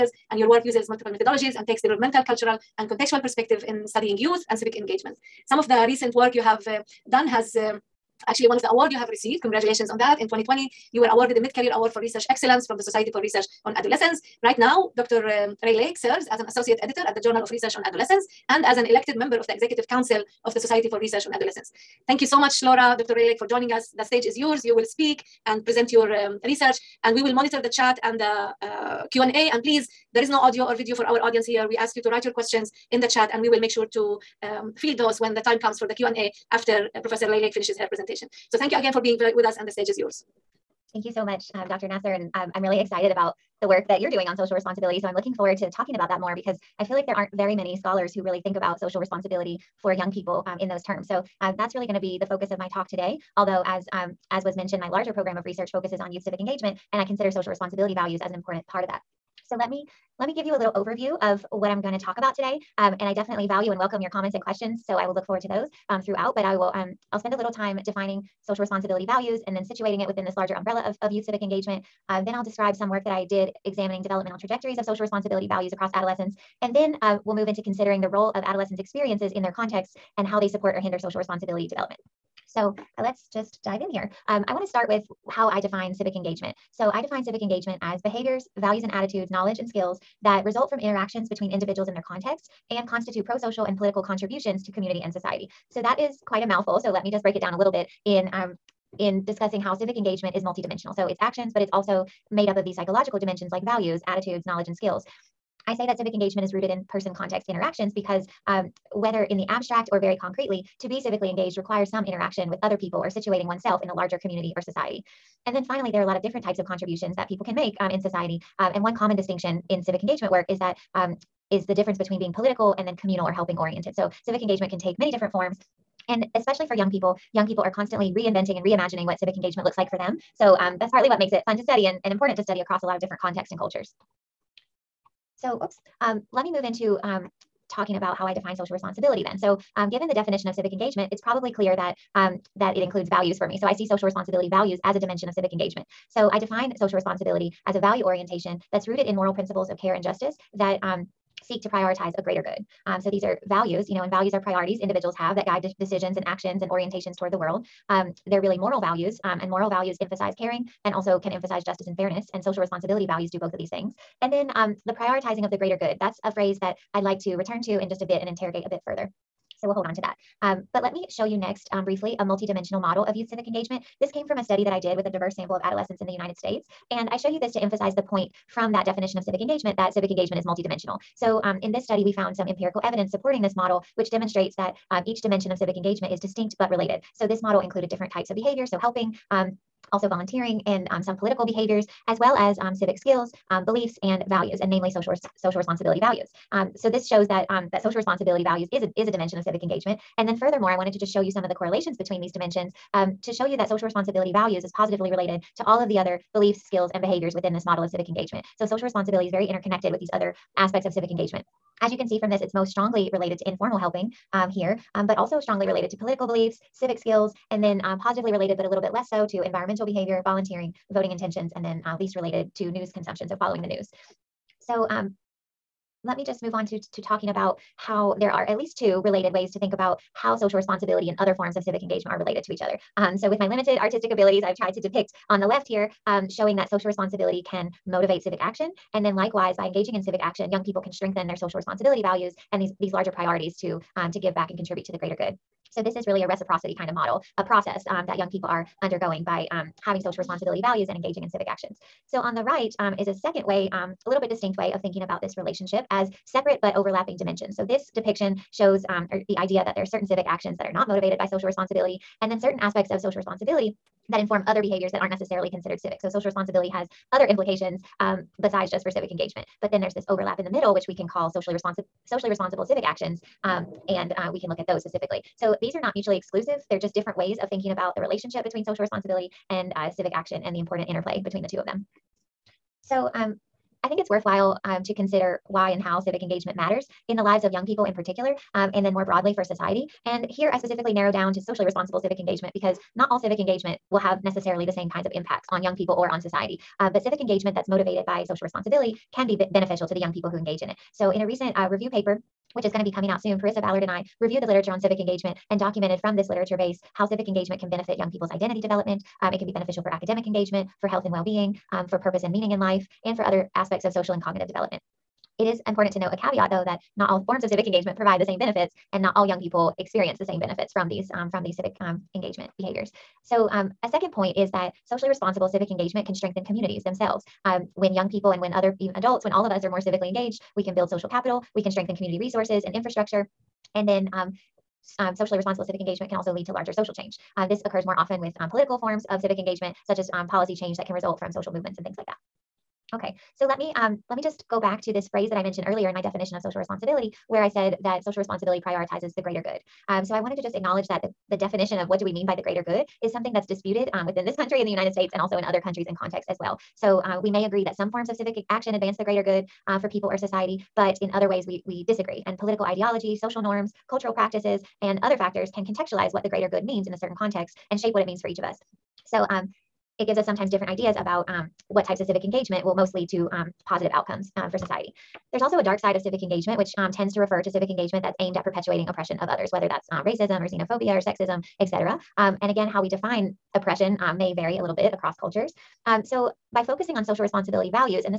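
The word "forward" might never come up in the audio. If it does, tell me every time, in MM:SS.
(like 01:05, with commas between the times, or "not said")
00:45, 01:05.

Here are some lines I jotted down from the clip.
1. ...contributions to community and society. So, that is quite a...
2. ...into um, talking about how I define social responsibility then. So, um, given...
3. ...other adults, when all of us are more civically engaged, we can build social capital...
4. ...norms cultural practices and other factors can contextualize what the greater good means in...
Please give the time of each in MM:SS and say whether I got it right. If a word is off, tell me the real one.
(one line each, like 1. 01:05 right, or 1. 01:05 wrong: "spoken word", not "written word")
1. 01:34 right
2. 02:16 right
3. 05:28 right
4. 06:03 right.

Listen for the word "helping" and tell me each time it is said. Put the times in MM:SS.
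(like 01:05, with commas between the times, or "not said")
02:03, 03:08, 03:33.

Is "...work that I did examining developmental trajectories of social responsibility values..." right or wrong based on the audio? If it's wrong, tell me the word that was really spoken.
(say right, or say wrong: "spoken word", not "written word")
right.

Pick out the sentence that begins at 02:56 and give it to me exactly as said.
And I show you this to emphasize the point from that definition of civic engagement that civic engagement is multidimensional.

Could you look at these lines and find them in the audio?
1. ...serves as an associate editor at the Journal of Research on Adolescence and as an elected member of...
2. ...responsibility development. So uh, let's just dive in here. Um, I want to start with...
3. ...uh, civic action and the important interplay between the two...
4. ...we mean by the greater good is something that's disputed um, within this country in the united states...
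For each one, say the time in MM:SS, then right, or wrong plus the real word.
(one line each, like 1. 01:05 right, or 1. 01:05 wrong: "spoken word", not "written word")
1. 00:15 right
2. 01:21 right
3. 04:39 right
4. 05:52 right.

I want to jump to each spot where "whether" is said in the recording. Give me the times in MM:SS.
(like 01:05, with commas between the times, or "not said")
01:48, 06:19.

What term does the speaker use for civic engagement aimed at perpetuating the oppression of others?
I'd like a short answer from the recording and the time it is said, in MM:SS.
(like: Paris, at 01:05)
Dark side of civic engagement, at 06:15.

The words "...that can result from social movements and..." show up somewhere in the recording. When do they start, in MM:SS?
05:40.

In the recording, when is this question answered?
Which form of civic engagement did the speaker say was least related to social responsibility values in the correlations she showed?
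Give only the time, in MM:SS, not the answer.
03:42.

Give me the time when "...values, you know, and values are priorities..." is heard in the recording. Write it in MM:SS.
02:33.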